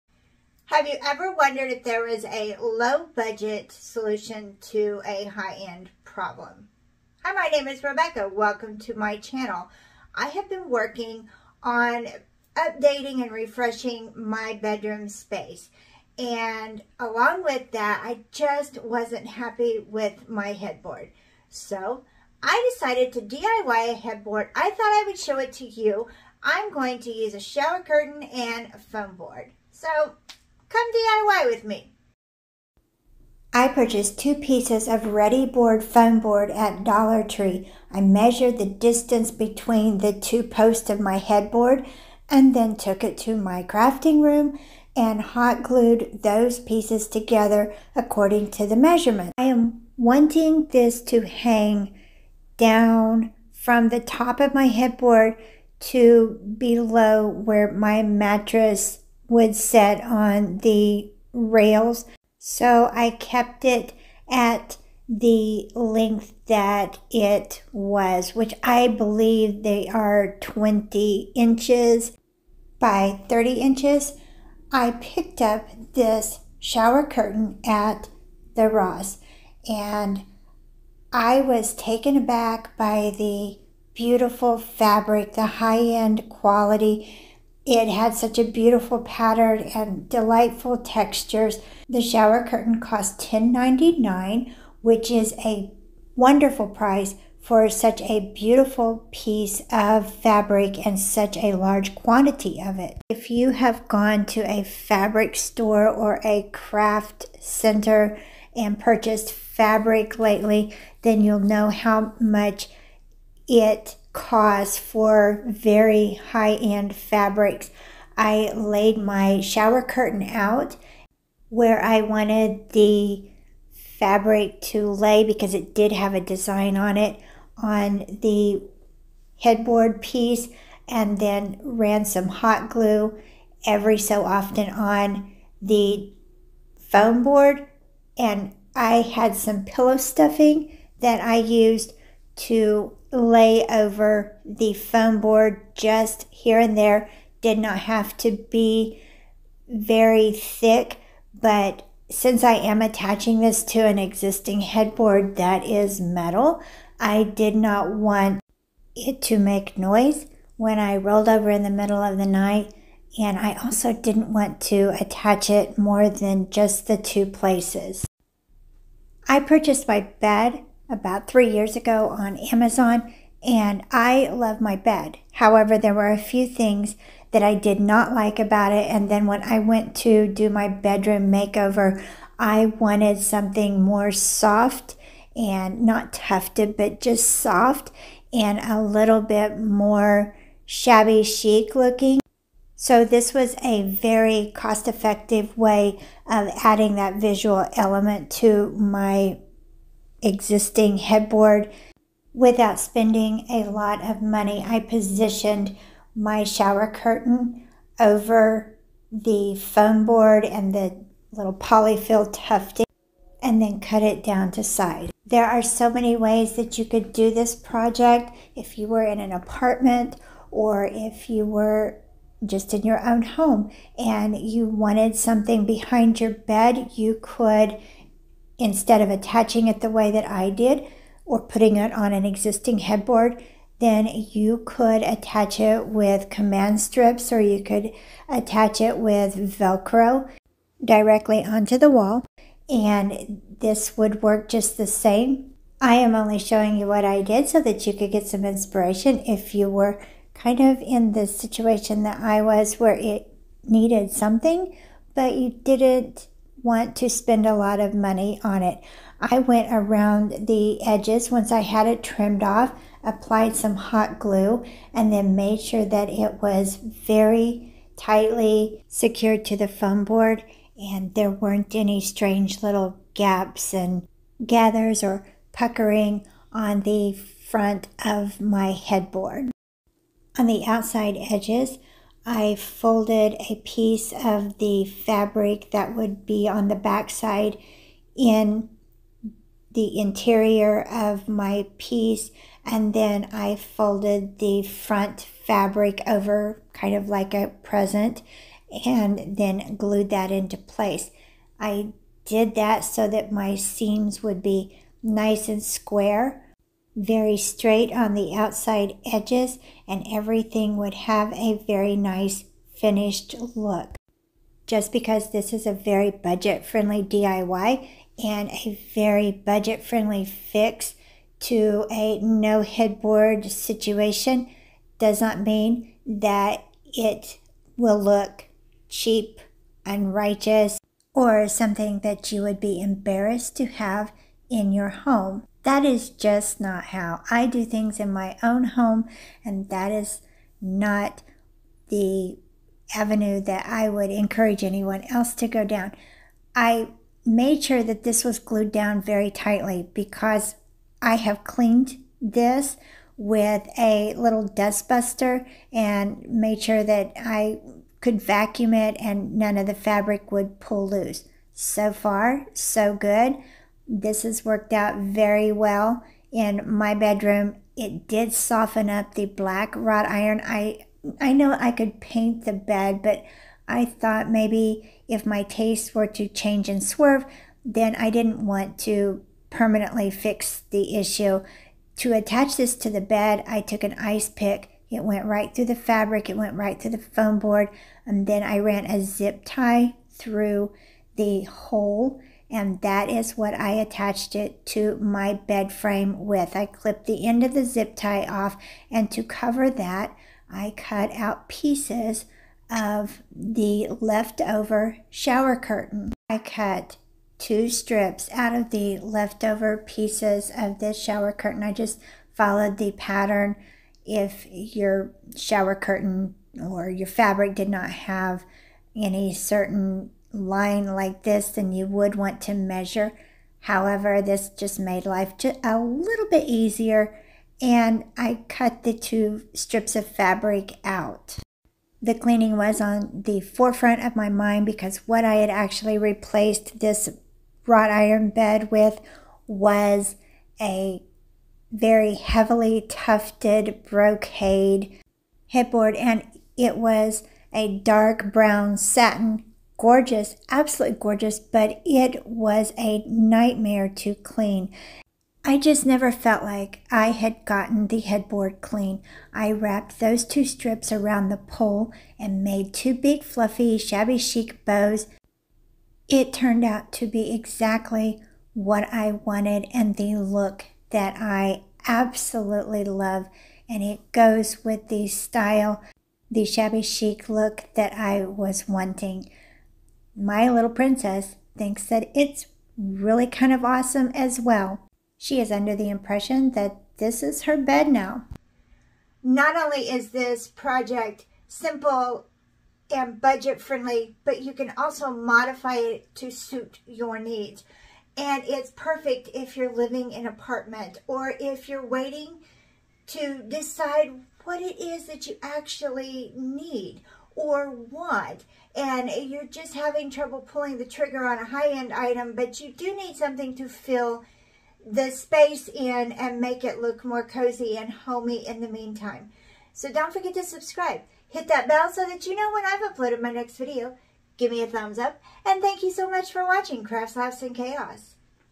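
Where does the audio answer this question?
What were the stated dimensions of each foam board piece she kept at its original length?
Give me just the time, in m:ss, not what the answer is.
1:10.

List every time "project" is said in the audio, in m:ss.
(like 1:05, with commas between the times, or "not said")
3:37, 8:10.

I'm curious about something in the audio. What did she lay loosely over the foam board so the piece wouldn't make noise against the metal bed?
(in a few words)
pillow stuffing.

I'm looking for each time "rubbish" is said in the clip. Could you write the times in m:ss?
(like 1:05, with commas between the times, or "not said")
not said.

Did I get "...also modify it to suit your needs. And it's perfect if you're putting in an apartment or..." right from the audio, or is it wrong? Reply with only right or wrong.
wrong.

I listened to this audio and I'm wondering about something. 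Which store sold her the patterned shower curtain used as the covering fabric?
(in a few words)
Ross.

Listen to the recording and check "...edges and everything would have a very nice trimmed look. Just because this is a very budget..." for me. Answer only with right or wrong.
wrong.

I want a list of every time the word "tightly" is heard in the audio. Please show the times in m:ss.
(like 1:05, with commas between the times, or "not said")
4:27, 5:49.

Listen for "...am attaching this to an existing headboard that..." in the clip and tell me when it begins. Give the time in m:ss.
2:32.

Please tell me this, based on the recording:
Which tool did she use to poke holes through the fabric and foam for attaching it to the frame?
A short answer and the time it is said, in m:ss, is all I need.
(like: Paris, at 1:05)
ice pick, at 6:23.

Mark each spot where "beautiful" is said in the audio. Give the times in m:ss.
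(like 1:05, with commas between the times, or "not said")
1:23, 1:28, 1:38.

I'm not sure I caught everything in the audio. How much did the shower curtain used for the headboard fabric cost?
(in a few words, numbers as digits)
$10.99.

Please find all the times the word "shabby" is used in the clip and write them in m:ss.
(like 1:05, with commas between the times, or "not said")
3:10, 7:43, 7:56.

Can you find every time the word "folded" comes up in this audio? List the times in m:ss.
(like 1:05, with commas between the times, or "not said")
4:42, 4:53.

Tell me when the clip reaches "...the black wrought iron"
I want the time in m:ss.
6:09.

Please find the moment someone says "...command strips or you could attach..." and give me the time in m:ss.
3:56.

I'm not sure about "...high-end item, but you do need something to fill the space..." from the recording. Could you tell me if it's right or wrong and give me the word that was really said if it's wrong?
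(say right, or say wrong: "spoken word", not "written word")
right.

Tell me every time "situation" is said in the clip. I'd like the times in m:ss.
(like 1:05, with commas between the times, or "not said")
4:11, 5:23.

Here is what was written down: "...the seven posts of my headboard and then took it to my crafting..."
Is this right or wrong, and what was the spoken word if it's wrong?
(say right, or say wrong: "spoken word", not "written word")
wrong: "two", not "seven".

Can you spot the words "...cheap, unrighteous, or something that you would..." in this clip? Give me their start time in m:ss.
5:28.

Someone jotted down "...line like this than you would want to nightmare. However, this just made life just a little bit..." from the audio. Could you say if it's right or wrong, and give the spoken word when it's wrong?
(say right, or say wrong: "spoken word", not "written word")
wrong: "measure", not "nightmare".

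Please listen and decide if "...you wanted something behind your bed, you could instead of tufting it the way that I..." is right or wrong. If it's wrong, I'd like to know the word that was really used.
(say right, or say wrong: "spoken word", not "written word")
wrong: "attaching", not "tufting".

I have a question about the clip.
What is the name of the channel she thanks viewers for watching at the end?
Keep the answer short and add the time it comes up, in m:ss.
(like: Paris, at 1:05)
Crafts, Laughs, and Chaos, at 8:46.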